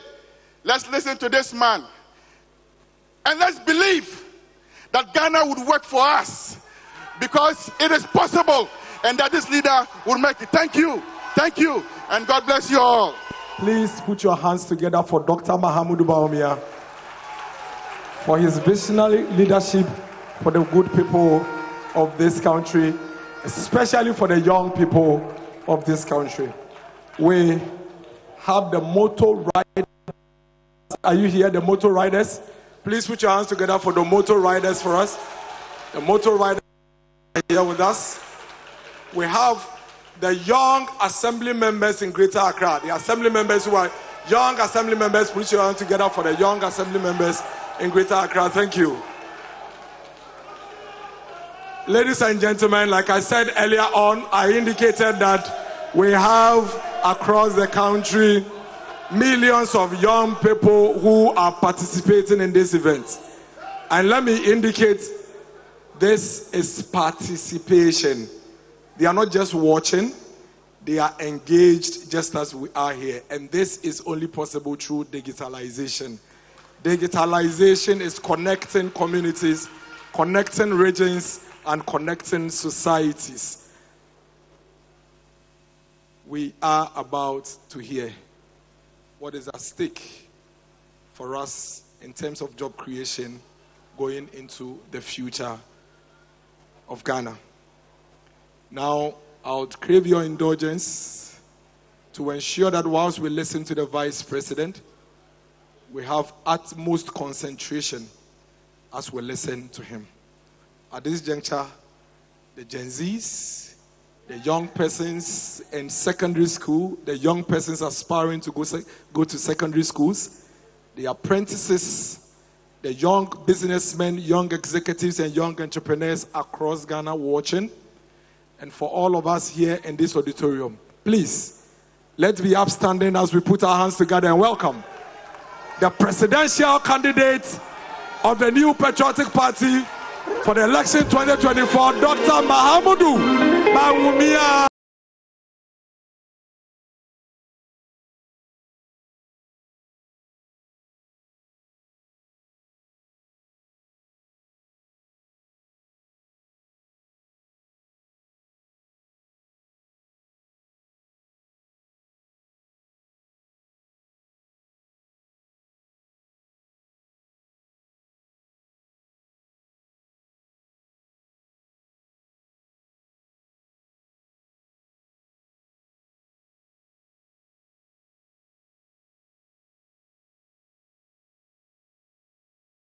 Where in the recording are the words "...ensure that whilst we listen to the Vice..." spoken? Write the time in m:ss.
1:42.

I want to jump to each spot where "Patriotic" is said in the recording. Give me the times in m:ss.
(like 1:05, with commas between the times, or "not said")
2:18.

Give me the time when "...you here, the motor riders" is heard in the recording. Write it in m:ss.
0:31.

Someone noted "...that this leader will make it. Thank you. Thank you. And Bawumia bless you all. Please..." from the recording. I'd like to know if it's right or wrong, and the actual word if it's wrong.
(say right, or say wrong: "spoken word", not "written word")
wrong: "God", not "Bawumia".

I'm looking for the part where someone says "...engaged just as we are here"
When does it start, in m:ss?
1:11.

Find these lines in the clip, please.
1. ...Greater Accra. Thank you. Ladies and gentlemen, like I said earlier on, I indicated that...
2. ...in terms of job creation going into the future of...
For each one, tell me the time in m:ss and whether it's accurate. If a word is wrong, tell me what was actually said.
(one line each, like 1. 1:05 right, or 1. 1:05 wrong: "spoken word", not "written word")
1. 0:47 right
2. 1:32 right.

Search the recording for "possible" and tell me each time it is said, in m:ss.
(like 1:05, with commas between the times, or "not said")
0:08, 1:14.